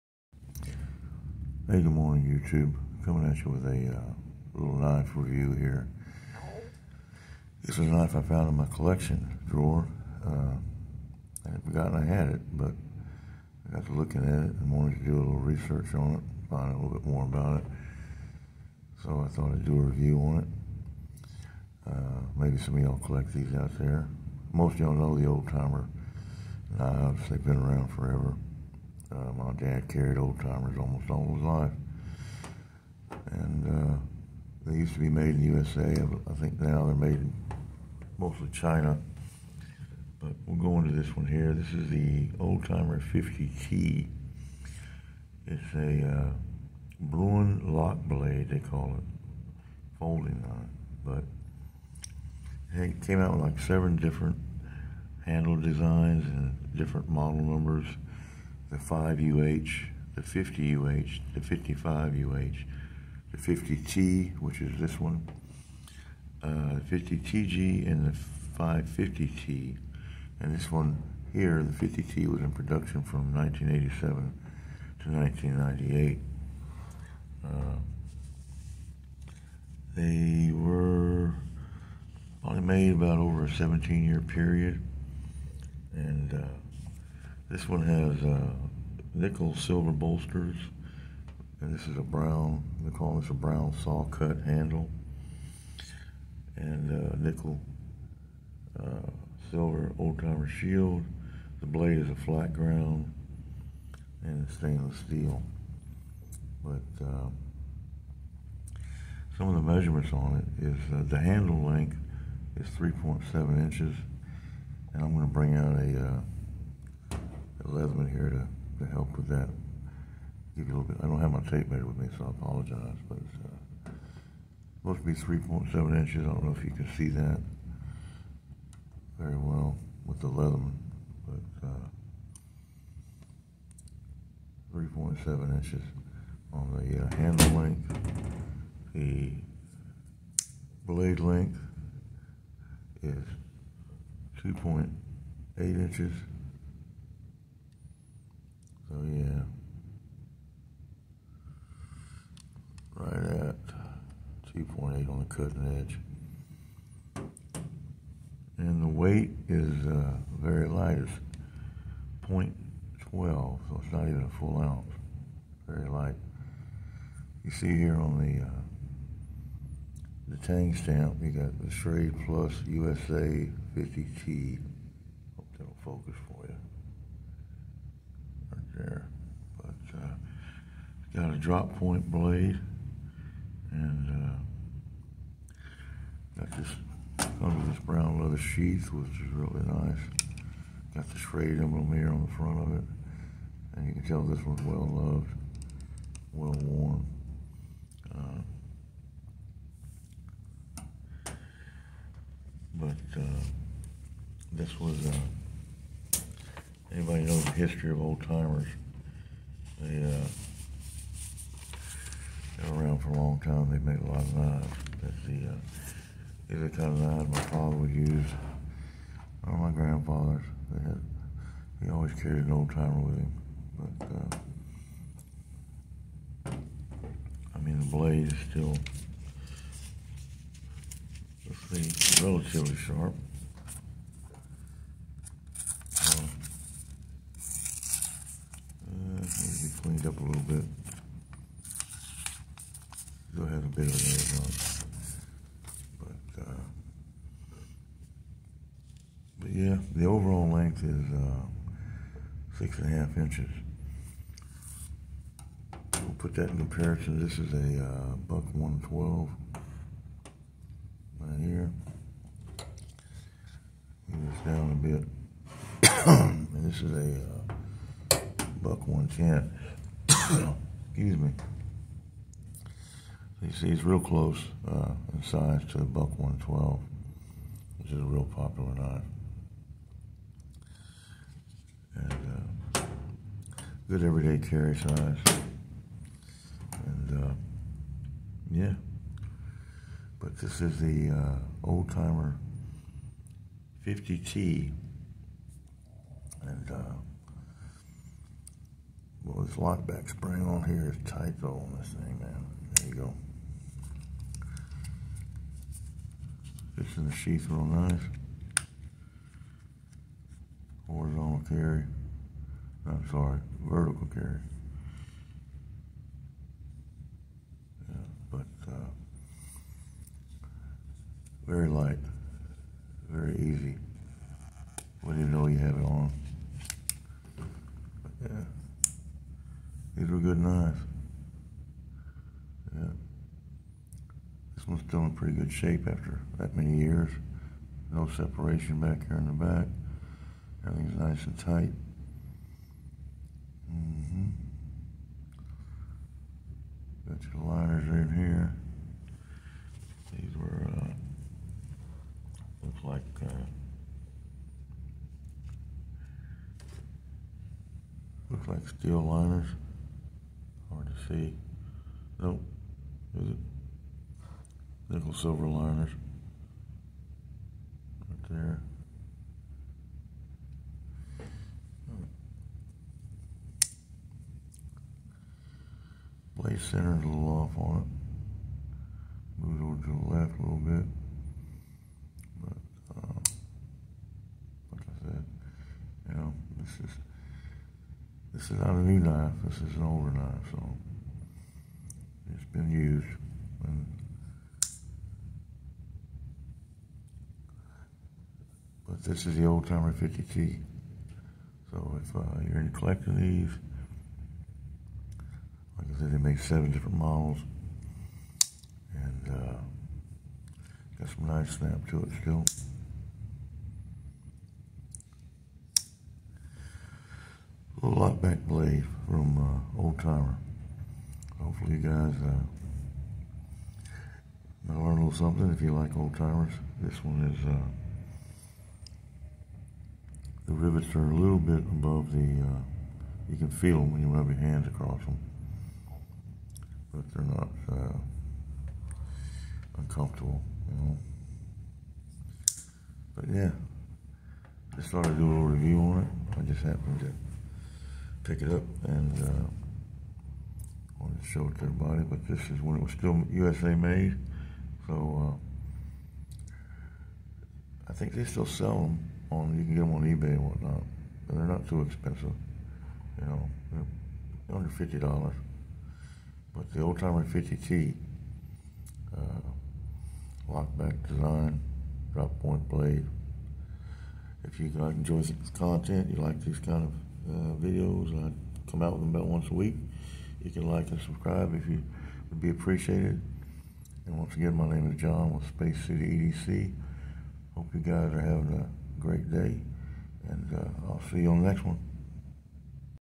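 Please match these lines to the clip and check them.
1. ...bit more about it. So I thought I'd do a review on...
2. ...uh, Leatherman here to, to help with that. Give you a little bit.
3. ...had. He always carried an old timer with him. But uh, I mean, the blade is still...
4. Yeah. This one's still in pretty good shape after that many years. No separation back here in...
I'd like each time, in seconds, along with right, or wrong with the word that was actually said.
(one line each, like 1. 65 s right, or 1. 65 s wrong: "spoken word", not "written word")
1. 16 s right
2. 116 s right
3. 220 s right
4. 332 s right.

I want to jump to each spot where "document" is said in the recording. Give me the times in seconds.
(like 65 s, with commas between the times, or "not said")
not said.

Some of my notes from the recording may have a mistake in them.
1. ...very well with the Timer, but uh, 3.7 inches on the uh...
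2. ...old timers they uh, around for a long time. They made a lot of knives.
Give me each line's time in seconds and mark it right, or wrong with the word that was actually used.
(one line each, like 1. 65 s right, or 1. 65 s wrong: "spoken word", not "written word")
1. 129 s wrong: "Leatherman", not "Timer"
2. 208 s right.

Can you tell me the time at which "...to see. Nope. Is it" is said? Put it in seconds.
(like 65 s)
360 s.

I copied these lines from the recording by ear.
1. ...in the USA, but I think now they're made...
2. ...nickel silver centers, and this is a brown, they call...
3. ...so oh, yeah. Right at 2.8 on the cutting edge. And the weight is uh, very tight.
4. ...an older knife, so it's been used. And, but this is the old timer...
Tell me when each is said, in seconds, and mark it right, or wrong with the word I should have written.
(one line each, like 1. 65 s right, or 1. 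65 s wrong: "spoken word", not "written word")
1. 35 s right
2. 89 s wrong: "bolsters", not "centers"
3. 148 s wrong: "light", not "tight"
4. 389 s right.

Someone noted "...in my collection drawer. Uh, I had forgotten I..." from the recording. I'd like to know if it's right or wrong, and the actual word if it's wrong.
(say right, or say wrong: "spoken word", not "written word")
right.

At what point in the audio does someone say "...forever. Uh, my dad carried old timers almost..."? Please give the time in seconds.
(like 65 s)
27 s.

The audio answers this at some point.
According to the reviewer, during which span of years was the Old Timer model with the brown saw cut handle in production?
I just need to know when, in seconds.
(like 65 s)
73 s.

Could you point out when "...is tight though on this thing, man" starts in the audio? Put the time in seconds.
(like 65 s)
300 s.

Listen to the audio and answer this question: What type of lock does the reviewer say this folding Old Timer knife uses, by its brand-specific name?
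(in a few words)
Bruin lock.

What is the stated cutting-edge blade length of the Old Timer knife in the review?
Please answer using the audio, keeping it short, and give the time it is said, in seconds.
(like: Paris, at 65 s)
2.8 inches, at 144 s.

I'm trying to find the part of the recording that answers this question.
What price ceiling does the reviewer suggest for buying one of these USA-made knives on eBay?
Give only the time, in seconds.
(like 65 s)
464 s.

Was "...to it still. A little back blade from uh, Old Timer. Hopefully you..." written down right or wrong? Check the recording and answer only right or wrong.
right.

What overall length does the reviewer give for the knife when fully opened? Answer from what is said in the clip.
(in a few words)
6.5 inches.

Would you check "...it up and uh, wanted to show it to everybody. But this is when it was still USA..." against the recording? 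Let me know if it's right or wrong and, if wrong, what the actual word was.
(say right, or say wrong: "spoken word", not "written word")
right.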